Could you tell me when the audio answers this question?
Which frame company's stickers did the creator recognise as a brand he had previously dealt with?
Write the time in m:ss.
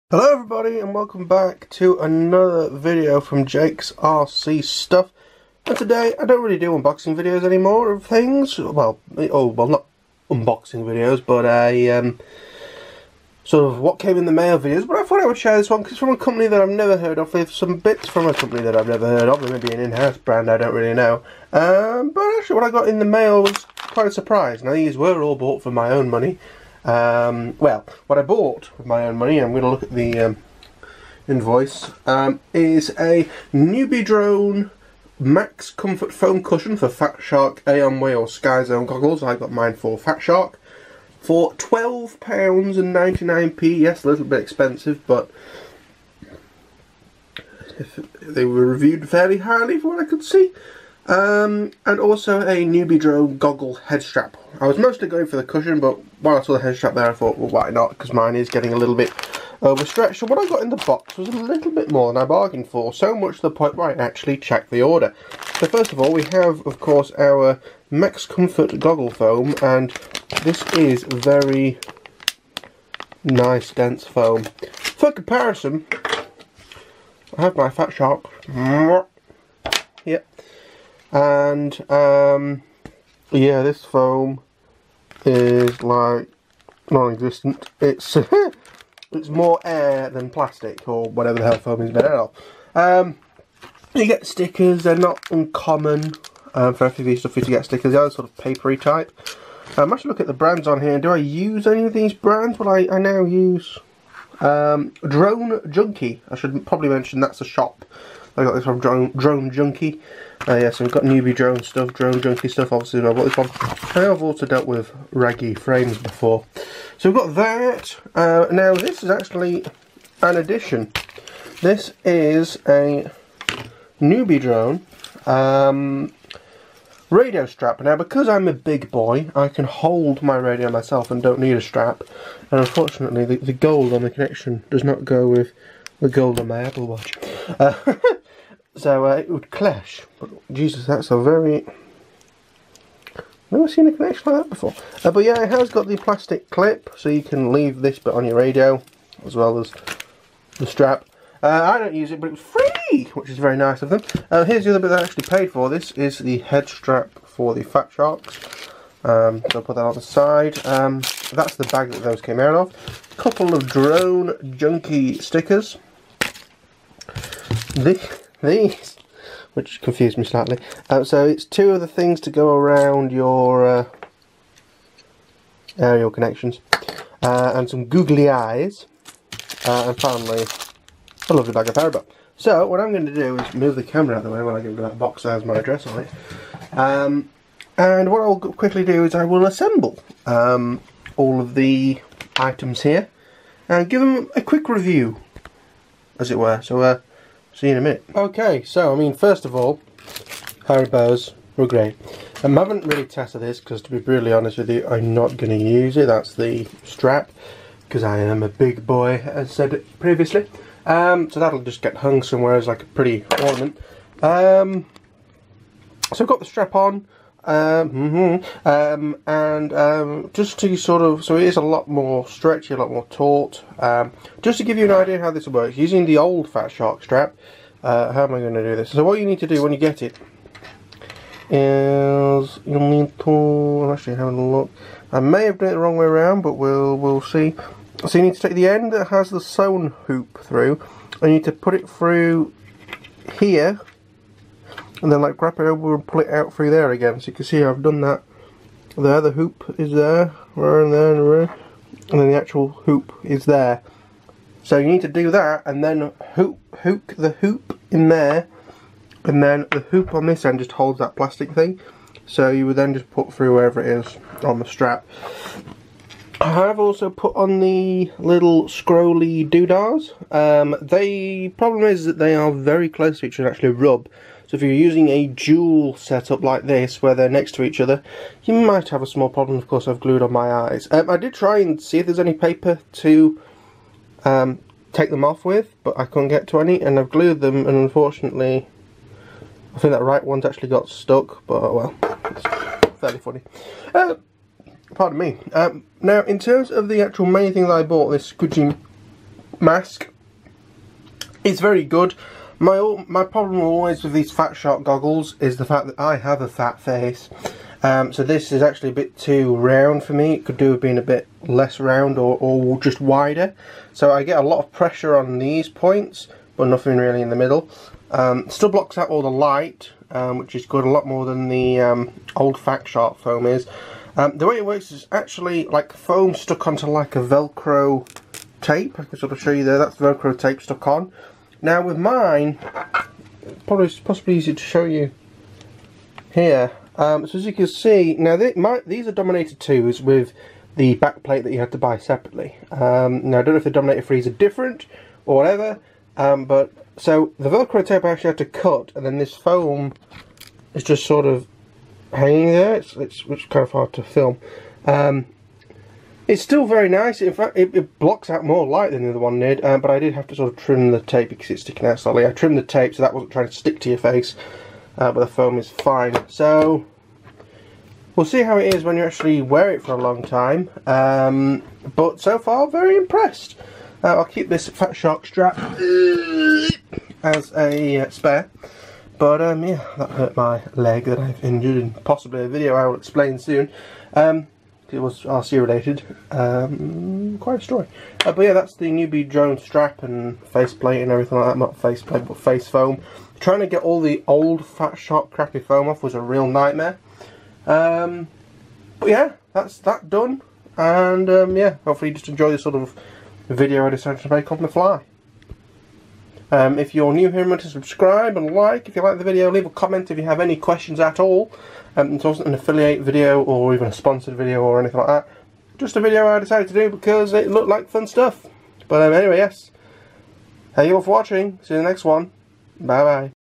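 1:55.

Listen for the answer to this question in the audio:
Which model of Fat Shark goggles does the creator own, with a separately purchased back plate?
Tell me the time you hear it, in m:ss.
5:39.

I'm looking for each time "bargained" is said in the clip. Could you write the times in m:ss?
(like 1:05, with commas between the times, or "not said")
1:02.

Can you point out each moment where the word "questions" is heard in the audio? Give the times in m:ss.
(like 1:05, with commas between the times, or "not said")
6:50.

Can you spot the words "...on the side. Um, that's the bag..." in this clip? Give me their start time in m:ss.
2:39.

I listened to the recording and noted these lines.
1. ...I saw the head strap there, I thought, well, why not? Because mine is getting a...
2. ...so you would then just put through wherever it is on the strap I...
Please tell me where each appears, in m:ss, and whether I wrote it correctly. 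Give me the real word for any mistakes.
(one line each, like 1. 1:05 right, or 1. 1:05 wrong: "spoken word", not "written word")
1. 0:56 right
2. 4:22 right.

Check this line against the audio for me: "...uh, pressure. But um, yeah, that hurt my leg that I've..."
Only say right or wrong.
wrong.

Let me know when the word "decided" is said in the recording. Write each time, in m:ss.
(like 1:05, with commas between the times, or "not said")
6:43, 6:56.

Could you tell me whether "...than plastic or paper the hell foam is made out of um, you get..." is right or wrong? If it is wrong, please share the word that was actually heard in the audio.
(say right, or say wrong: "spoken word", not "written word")
wrong: "whatever", not "paper".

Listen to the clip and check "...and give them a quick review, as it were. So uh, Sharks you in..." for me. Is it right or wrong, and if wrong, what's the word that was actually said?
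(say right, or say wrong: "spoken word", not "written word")
wrong: "See", not "Sharks".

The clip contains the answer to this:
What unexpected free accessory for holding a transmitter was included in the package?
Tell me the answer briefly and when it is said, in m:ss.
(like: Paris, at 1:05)
Radio strap, at 2:07.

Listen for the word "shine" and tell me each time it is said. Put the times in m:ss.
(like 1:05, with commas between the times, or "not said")
not said.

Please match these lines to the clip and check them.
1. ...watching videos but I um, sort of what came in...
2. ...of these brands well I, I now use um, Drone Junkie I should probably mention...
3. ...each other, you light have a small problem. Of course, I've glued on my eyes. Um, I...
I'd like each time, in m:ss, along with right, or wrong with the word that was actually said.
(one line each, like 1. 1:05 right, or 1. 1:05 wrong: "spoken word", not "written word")
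1. 0:10 wrong: "unboxing", not "watching"
2. 1:41 right
3. 4:37 wrong: "might", not "light".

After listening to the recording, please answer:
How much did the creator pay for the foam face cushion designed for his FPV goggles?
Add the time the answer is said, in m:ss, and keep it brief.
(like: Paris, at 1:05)
£12.99, at 0:41.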